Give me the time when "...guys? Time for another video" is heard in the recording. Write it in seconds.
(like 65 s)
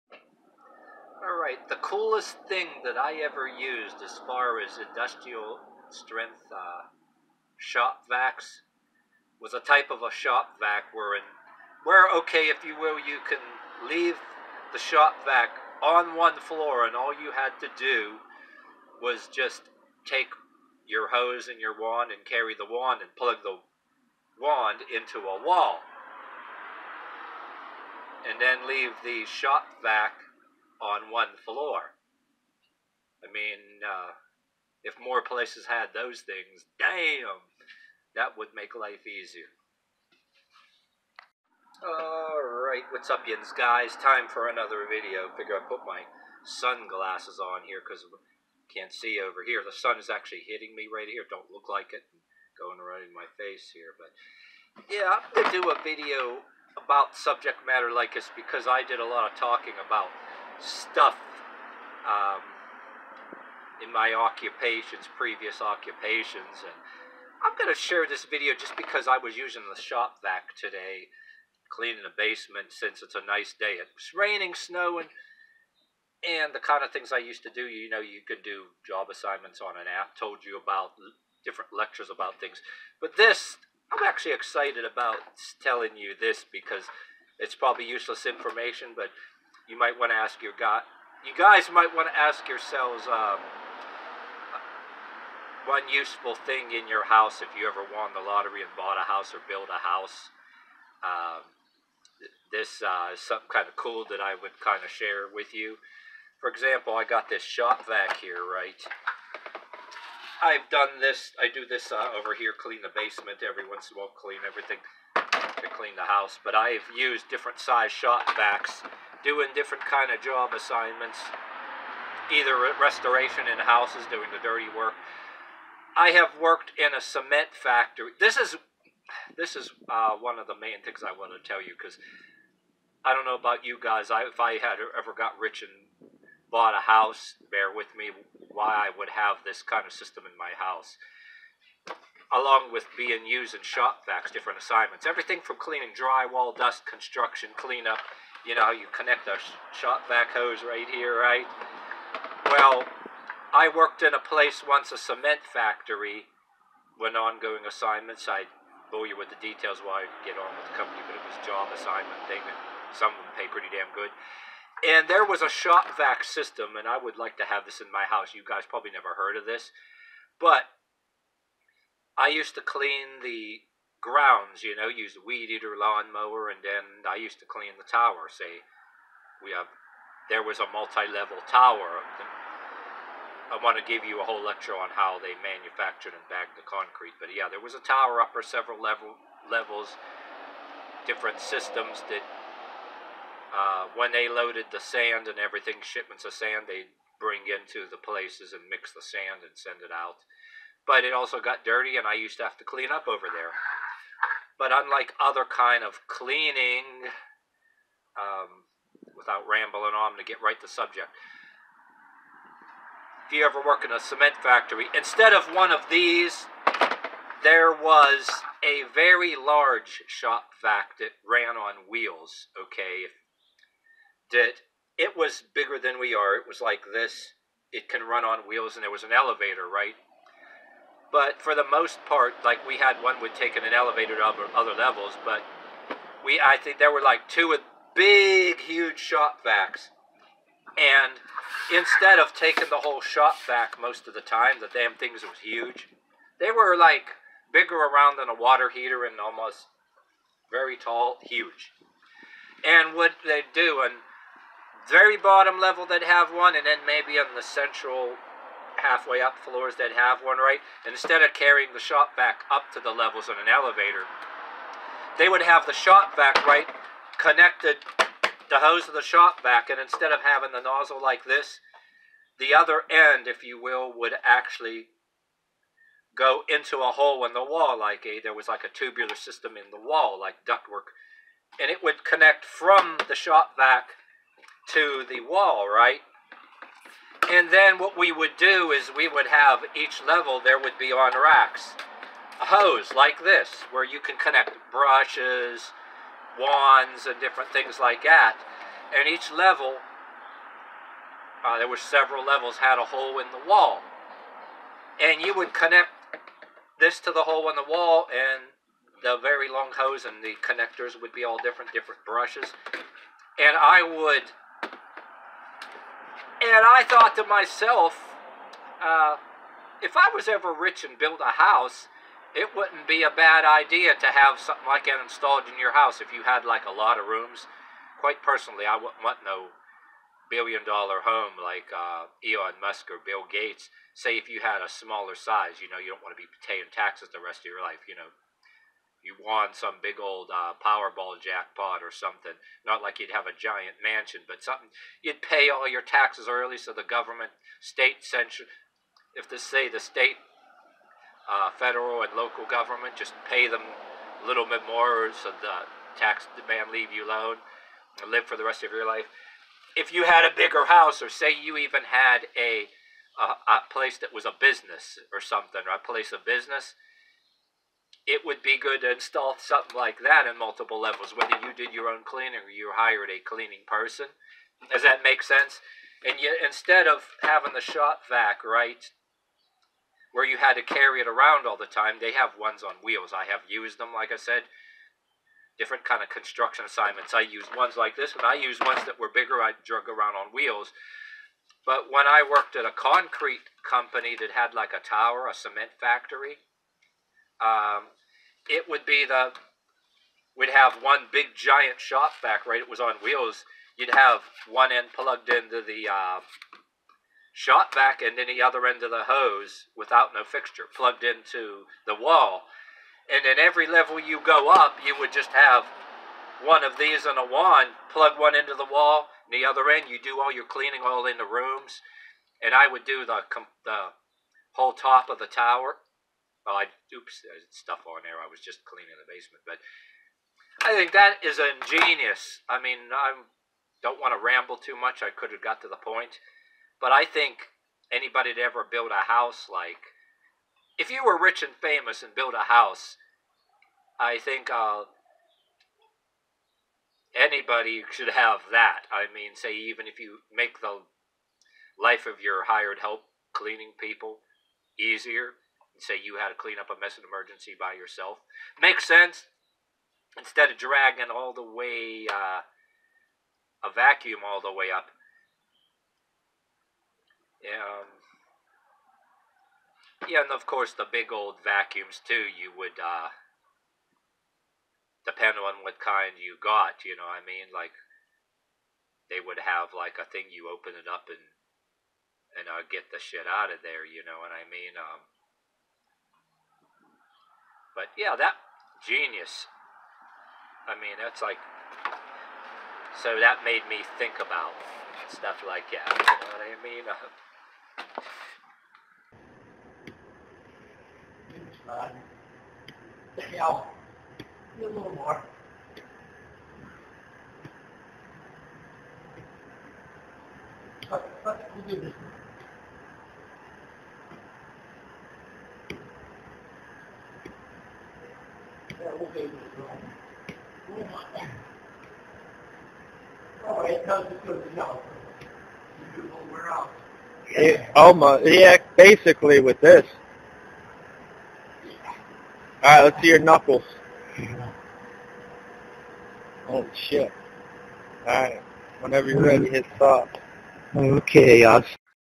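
43 s.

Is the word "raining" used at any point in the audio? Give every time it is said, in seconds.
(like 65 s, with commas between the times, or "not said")
74 s.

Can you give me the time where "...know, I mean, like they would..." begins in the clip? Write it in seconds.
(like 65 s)
476 s.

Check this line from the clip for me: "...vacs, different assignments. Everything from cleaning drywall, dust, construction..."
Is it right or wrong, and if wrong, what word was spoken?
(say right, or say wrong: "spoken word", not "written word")
right.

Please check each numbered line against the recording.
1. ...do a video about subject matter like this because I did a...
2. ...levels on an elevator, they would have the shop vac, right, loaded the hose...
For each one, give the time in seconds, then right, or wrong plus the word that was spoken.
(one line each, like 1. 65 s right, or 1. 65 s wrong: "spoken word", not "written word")
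1. 55 s right
2. 262 s wrong: "connected", not "loaded".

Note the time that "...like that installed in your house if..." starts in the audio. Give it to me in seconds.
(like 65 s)
324 s.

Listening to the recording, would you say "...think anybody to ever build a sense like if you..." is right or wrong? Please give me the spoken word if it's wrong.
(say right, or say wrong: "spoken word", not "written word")
wrong: "house", not "sense".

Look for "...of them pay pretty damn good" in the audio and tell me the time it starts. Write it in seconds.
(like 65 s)
163 s.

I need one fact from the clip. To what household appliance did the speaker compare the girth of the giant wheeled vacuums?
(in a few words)
water heater.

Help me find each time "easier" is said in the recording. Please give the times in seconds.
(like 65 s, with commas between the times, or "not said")
39 s, 454 s.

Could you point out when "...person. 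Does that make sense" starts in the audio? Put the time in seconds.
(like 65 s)
373 s.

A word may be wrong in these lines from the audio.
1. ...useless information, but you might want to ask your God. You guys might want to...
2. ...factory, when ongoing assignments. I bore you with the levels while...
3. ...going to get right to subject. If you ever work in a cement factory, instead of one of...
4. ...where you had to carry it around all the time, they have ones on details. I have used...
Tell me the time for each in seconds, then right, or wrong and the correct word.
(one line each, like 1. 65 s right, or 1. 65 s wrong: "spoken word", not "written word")
1. 87 s right
2. 155 s wrong: "details", not "levels"
3. 210 s right
4. 380 s wrong: "wheels", not "details".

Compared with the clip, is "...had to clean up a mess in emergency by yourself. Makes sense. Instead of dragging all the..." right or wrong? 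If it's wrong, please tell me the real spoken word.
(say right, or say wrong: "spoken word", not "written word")
right.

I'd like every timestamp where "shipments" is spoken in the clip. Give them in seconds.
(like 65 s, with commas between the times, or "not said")
195 s.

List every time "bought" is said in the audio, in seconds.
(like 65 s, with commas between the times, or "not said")
98 s, 136 s.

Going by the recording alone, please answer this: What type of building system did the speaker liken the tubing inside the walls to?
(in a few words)
ductwork.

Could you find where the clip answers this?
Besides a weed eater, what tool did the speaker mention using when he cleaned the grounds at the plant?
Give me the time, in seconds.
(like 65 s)
175 s.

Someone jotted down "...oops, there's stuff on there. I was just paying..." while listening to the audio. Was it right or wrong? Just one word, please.
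wrong.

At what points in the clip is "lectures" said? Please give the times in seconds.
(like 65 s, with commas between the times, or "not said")
81 s, 184 s.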